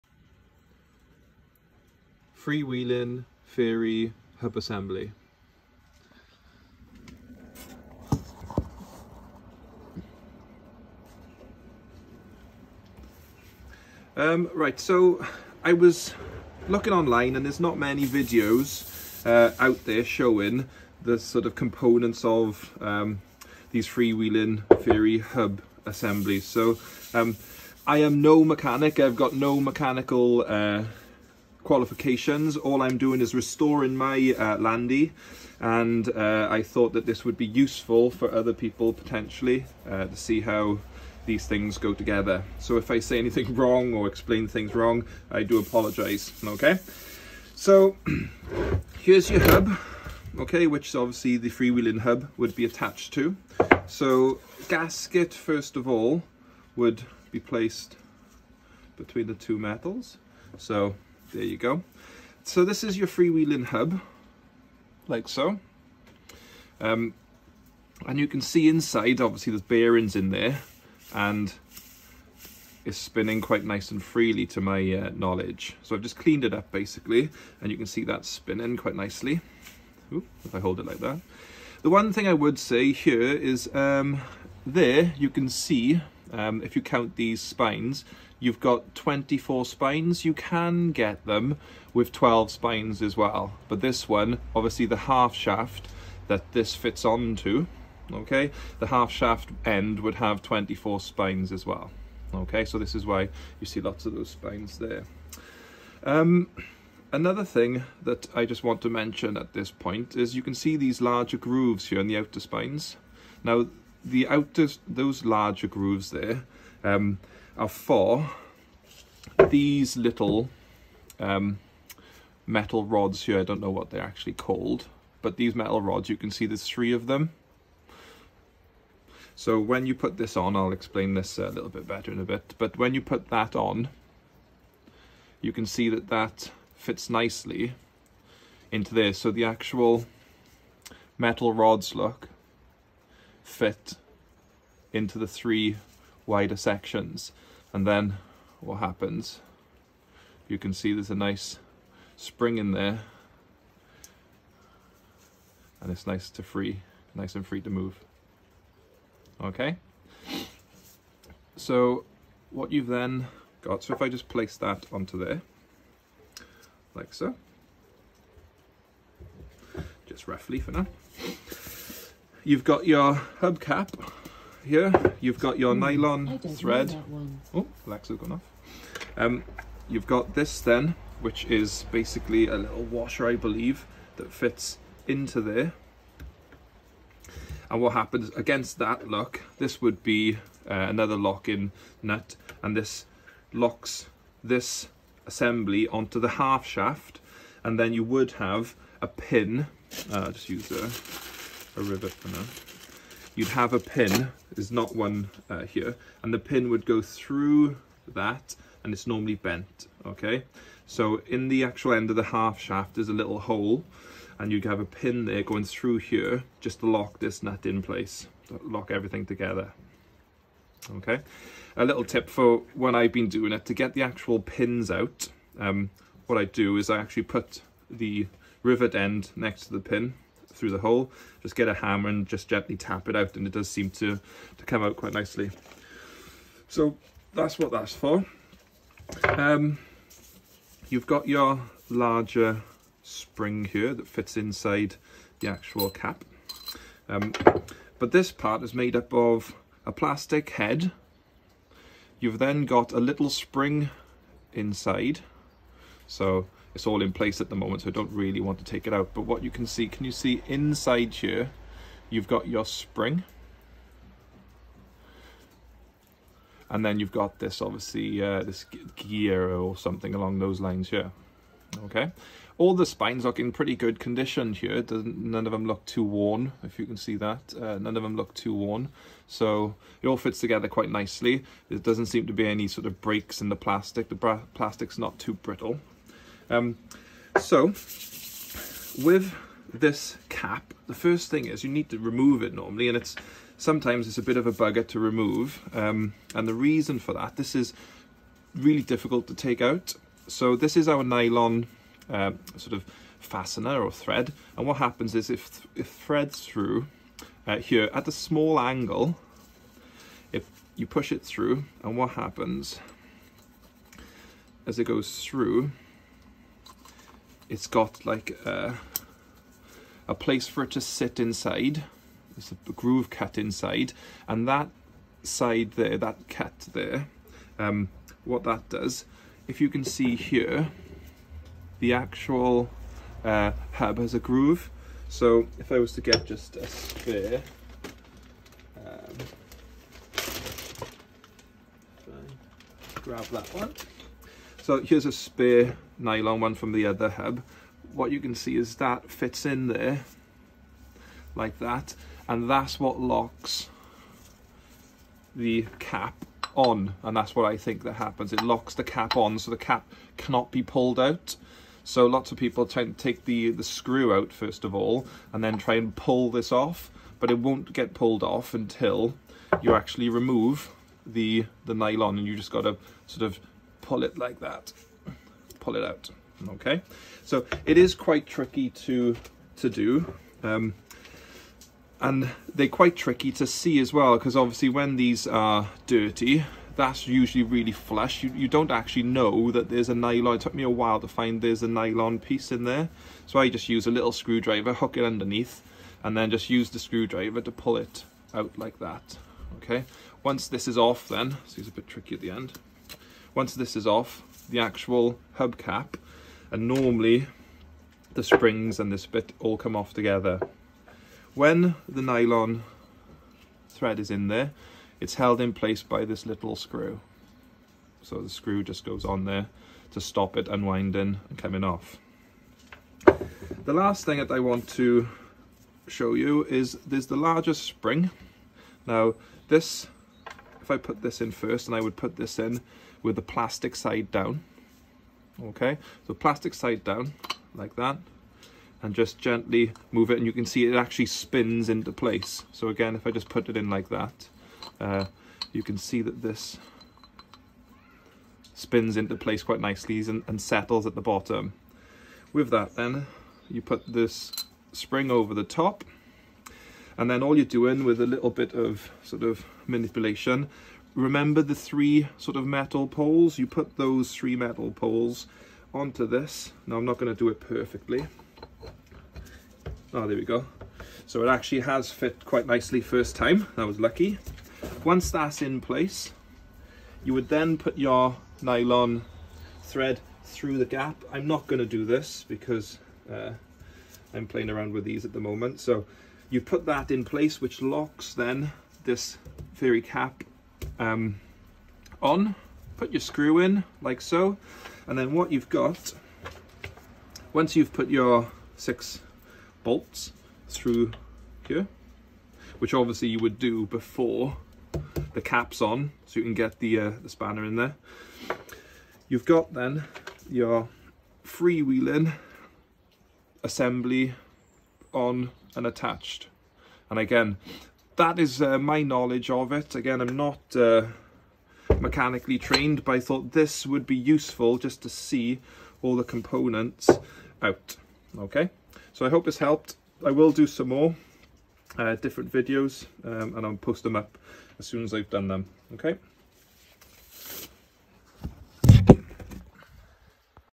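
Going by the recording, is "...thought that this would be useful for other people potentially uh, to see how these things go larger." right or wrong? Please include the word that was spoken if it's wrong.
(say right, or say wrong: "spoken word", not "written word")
wrong: "together", not "larger".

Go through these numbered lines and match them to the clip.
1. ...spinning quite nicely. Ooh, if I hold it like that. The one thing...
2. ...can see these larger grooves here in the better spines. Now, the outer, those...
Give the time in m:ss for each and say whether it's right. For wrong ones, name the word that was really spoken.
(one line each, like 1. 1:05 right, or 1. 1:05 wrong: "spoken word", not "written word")
1. 1:18 right
2. 1:50 wrong: "outer", not "better".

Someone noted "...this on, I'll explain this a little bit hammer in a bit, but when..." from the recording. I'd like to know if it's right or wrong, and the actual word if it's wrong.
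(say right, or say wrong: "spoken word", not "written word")
wrong: "better", not "hammer".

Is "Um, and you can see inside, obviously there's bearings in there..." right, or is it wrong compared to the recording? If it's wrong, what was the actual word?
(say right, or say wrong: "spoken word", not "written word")
right.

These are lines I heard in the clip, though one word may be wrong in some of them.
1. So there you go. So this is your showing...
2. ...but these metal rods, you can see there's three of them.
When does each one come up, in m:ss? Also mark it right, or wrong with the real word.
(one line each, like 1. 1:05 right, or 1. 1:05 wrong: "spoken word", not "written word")
1. 1:00 wrong: "freewheeling", not "showing"
2. 2:05 right.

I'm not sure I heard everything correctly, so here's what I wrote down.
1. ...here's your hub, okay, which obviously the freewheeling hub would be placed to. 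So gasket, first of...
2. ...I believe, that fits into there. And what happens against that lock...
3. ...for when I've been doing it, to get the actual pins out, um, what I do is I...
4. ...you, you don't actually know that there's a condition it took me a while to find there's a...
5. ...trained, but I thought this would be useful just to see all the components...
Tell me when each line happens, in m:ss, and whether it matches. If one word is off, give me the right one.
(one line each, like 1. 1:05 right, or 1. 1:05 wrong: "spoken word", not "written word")
1. 0:48 wrong: "attached", not "placed"
2. 3:03 right
3. 3:42 right
4. 6:28 wrong: "nylon", not "condition"
5. 8:42 right.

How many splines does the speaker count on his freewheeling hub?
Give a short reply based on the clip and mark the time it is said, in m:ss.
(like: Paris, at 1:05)
24, at 1:28.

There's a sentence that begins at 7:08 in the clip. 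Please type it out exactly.
Now this, if I put this in first and I would put this in, with the plastic side down.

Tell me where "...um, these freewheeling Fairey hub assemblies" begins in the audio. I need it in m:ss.
0:22.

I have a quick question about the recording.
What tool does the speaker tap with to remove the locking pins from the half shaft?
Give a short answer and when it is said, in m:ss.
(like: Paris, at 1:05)
A hammer, at 3:51.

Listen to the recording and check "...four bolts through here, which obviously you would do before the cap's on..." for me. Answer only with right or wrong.
wrong.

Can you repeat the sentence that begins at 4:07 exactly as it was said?
Um, but this part is made up of a plastic head.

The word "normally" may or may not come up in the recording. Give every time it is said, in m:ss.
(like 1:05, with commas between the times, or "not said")
3:29, 4:52, 6:46.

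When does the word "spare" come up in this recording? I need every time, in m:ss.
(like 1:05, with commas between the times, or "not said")
5:36, 5:45.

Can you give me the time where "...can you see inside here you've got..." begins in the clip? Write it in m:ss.
4:19.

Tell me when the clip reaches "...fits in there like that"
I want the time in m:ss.
5:49.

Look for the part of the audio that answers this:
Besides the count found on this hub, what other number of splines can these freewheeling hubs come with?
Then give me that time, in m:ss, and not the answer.
1:32.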